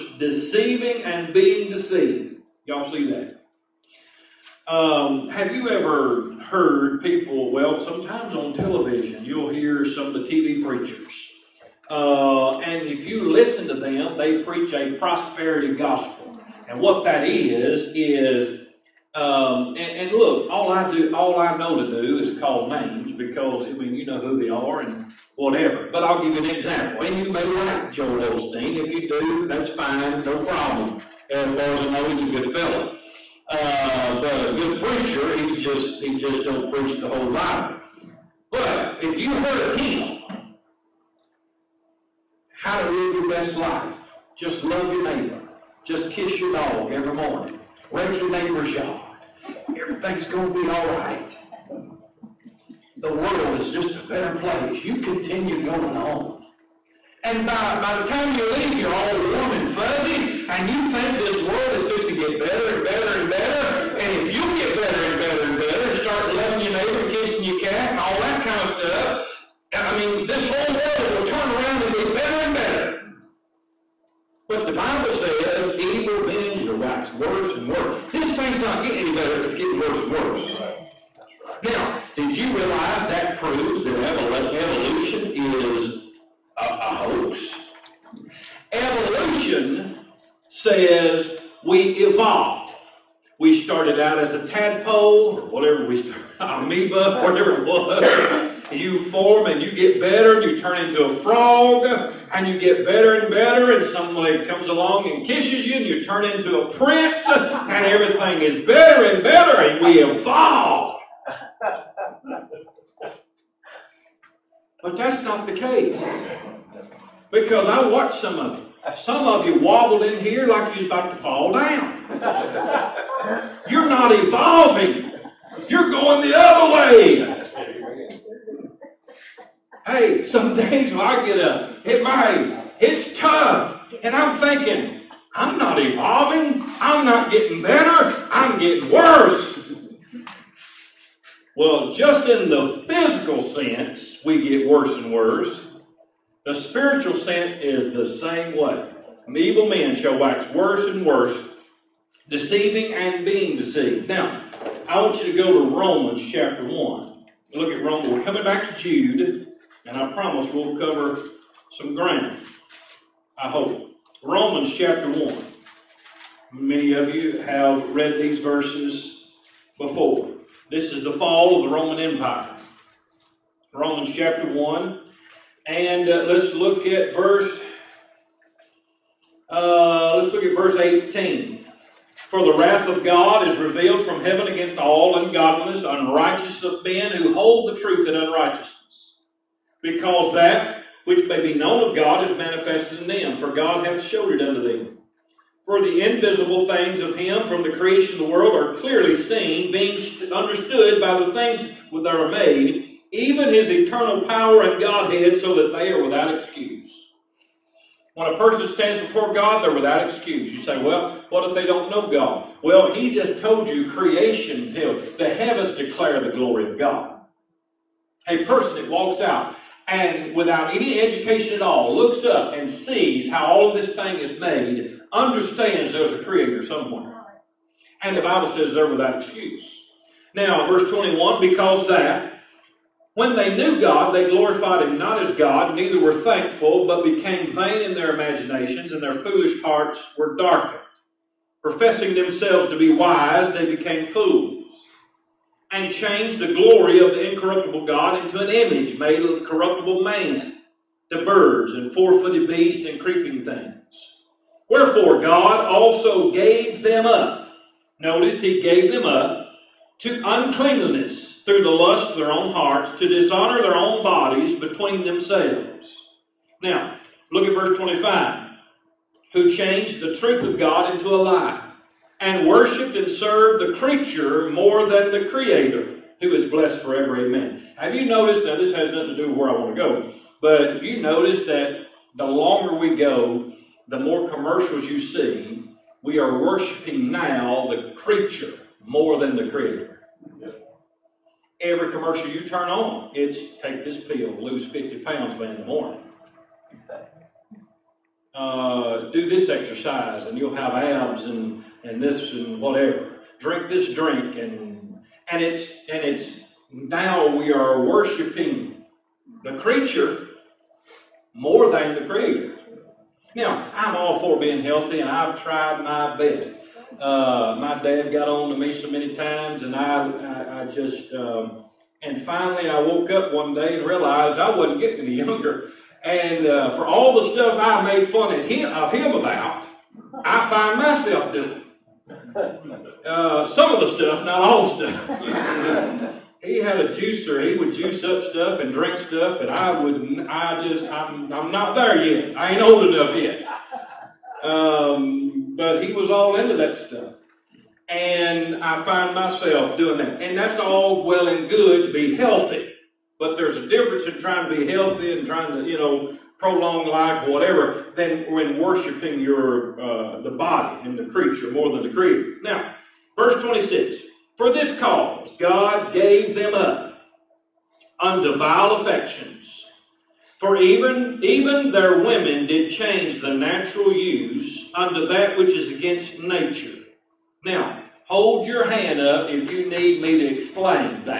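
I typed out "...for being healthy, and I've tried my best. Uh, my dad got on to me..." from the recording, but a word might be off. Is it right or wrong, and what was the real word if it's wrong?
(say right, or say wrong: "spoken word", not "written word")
right.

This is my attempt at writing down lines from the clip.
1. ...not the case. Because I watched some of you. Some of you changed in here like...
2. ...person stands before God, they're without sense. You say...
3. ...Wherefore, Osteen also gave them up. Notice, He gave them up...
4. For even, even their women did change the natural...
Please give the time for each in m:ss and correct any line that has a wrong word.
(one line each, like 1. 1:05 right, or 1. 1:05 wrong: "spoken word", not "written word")
1. 1:55 wrong: "wobbled", not "changed"
2. 3:28 wrong: "excuse", not "sense"
3. 4:14 wrong: "God", not "Osteen"
4. 6:10 right.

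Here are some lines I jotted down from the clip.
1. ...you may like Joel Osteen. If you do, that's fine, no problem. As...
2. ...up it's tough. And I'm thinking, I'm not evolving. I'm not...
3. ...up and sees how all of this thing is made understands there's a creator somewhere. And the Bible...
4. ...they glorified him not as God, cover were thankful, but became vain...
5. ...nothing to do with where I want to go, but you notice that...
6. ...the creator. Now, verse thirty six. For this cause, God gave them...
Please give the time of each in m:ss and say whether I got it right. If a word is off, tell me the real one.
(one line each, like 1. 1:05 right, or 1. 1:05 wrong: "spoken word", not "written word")
1. 0:27 right
2. 2:11 right
3. 3:42 right
4. 3:54 wrong: "neither", not "cover"
5. 4:38 right
6. 6:01 wrong: "twenty", not "thirty".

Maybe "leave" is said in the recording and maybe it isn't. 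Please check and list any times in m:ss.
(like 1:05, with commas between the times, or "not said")
0:58.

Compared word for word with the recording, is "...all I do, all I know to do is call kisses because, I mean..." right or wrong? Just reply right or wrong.
wrong.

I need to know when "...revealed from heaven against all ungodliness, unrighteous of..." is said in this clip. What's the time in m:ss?
3:03.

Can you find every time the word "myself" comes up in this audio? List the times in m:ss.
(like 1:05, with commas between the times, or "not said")
5:30, 5:49.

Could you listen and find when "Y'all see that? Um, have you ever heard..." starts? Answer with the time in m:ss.
0:02.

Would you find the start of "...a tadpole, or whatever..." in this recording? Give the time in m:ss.
1:34.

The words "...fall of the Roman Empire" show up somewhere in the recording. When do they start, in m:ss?
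2:51.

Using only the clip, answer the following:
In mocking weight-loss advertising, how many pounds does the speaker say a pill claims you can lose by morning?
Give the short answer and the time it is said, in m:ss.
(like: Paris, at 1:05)
50, at 4:54.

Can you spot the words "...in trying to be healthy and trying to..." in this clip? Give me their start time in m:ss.
5:54.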